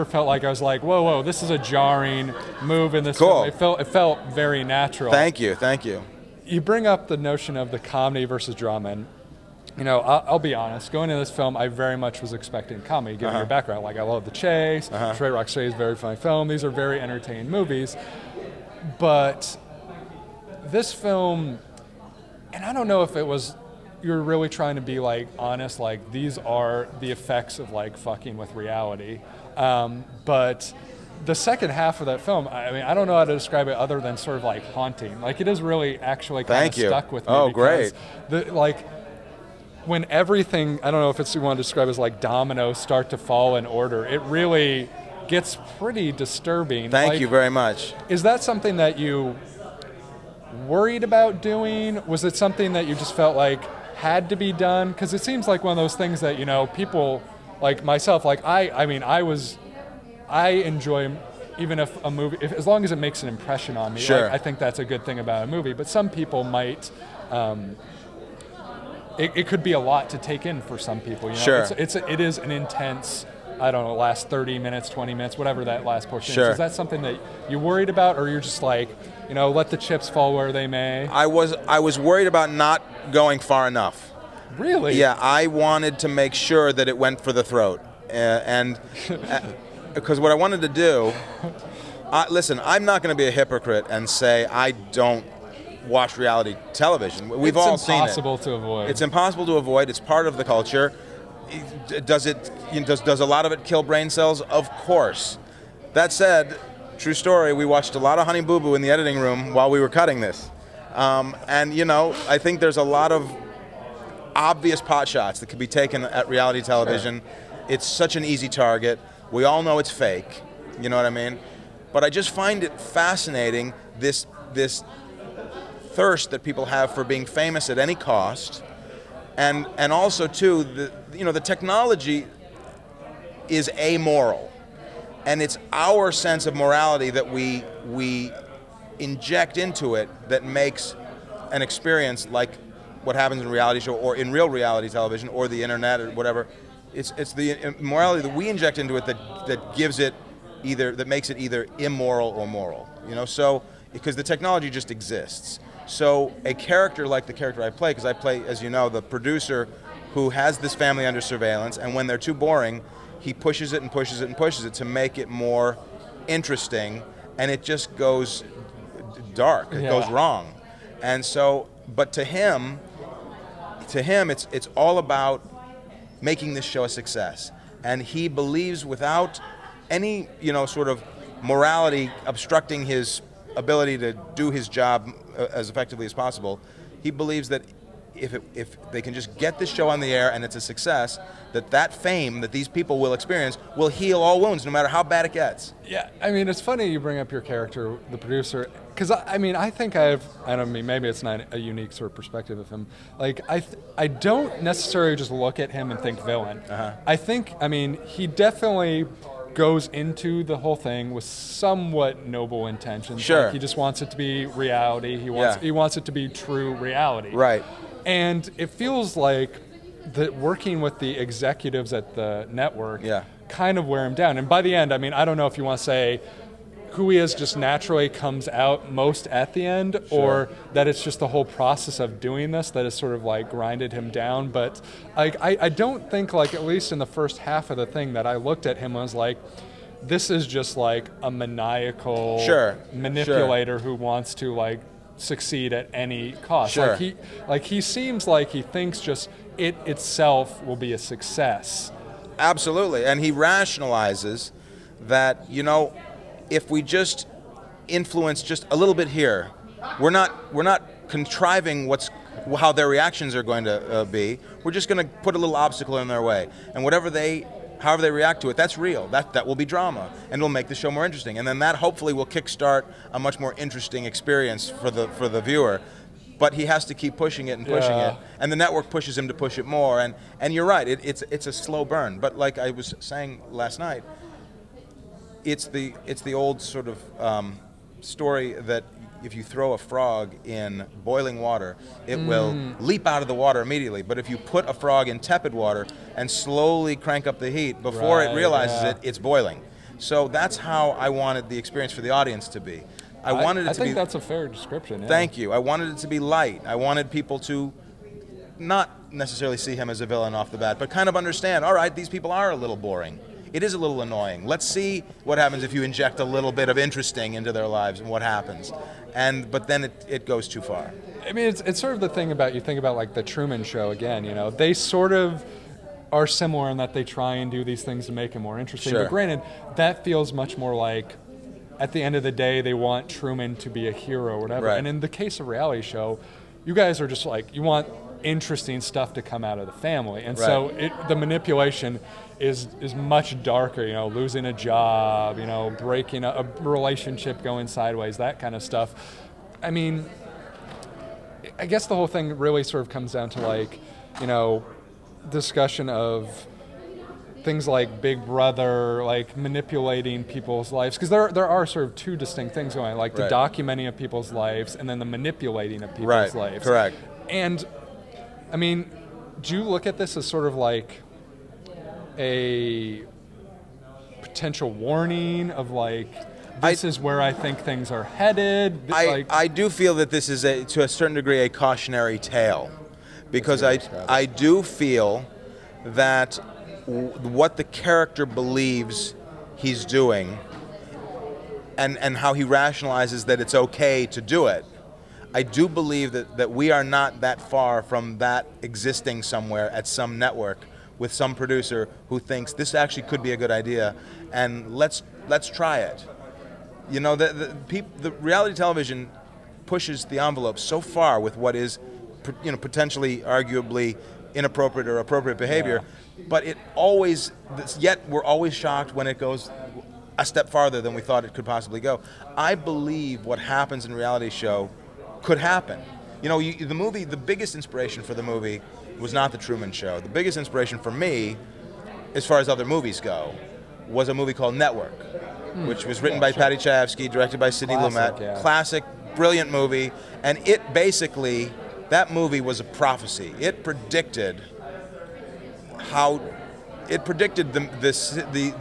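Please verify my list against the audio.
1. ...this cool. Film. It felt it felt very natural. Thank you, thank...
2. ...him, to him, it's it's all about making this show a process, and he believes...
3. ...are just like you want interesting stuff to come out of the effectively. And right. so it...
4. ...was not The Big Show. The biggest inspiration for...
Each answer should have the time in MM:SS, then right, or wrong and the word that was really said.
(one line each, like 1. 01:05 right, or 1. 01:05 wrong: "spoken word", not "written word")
1. 00:03 right
2. 02:52 wrong: "success", not "process"
3. 05:37 wrong: "family", not "effectively"
4. 07:09 wrong: "Truman", not "Big".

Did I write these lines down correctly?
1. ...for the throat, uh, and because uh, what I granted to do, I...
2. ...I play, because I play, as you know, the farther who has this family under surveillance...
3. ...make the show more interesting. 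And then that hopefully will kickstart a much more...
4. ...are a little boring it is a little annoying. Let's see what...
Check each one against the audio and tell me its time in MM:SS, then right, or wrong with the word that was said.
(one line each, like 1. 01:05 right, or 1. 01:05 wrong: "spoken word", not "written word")
1. 01:27 wrong: "wanted", not "granted"
2. 02:37 wrong: "producer", not "farther"
3. 04:30 right
4. 05:12 right.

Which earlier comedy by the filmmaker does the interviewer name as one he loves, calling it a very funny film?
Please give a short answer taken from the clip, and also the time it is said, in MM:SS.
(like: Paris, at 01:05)
Trey Rock Chase, at 00:15.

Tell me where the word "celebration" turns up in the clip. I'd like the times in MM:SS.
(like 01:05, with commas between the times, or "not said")
not said.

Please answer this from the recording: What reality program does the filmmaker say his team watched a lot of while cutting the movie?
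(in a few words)
Honey Boo Boo.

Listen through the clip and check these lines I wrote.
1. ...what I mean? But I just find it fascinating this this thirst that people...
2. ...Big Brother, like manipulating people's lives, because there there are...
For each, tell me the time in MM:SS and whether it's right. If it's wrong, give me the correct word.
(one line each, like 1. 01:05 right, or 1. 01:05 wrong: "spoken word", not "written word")
1. 02:00 right
2. 05:58 right.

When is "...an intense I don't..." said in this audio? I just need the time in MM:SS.
01:12.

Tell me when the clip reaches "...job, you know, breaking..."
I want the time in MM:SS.
05:44.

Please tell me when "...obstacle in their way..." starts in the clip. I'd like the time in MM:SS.
04:25.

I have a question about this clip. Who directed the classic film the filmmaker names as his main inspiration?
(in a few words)
Sidney Lumet.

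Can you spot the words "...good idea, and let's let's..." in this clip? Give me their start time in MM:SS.
06:43.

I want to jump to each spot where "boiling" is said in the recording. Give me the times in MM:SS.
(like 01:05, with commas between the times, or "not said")
04:51, 04:59.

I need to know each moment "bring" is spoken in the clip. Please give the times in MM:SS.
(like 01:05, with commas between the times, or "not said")
00:06, 03:17.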